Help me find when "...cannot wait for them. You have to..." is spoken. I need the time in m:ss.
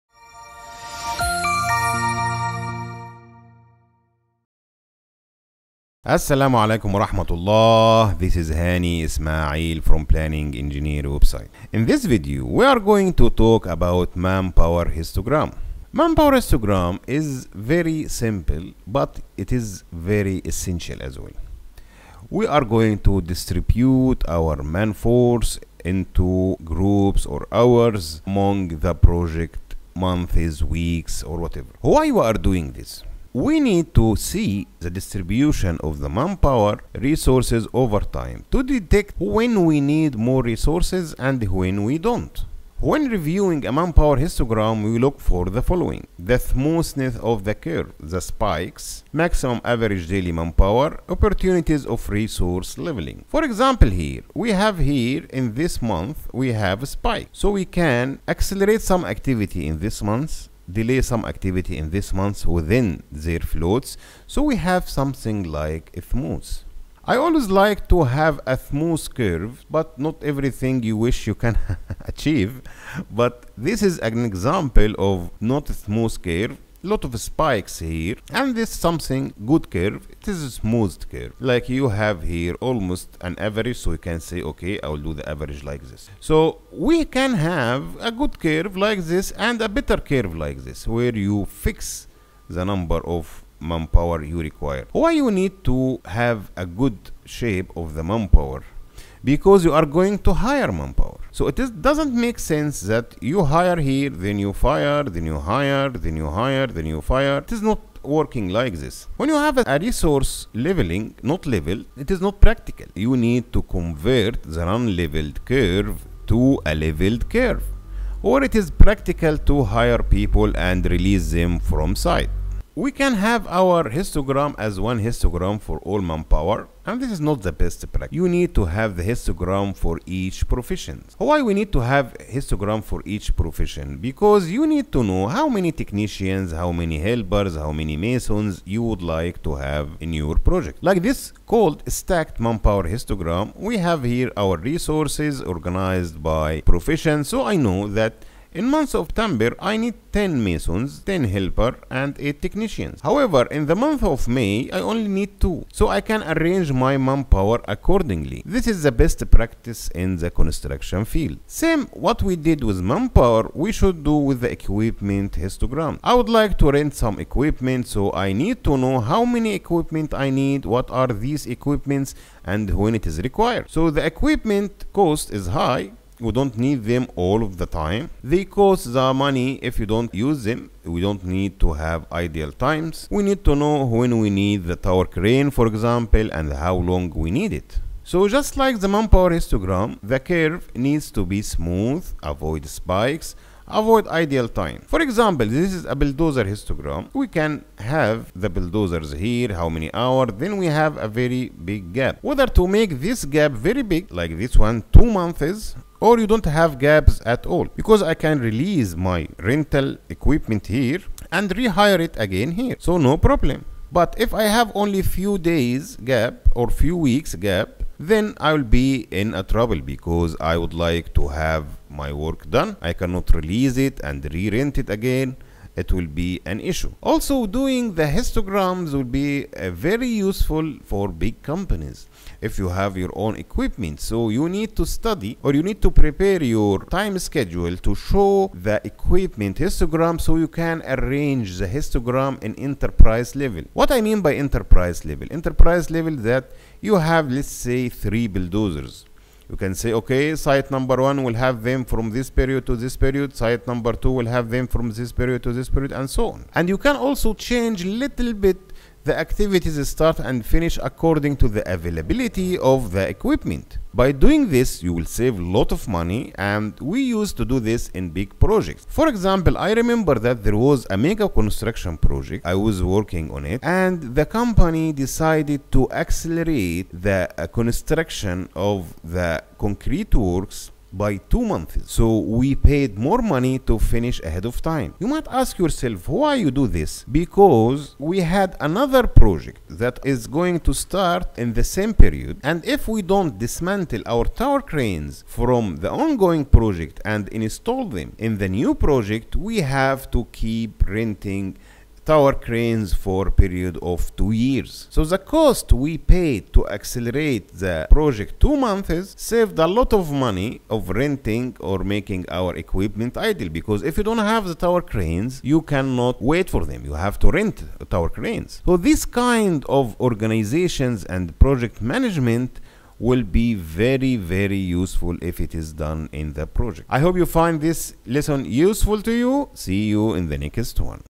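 5:15.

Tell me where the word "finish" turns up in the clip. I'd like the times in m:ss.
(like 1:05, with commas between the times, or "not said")
4:20, 4:43.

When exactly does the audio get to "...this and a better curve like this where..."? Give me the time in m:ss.
1:29.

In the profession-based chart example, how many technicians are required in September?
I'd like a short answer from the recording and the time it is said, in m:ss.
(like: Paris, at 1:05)
8, at 2:32.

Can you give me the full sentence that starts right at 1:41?
So it is, doesn't make sense that you hire here, then you fire, then you hire, then you hire, then you fire.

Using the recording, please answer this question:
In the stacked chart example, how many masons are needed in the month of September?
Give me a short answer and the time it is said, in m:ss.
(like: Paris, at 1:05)
10, at 2:30.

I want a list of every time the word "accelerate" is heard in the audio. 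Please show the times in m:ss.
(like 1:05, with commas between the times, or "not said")
0:58, 4:35, 5:06.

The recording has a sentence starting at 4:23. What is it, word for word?
By doing this, you will save a lot of money and we used to do this in big projects.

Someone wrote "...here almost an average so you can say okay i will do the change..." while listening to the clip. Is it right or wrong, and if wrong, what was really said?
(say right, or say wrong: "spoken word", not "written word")
wrong: "average", not "change".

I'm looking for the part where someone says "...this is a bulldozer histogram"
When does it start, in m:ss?
3:15.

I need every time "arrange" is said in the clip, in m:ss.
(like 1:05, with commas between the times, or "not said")
2:36, 4:00.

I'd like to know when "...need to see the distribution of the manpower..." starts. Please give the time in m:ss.
0:33.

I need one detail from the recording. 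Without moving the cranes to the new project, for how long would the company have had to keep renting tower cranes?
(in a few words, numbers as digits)
2 years.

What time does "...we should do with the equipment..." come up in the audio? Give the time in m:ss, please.
2:43.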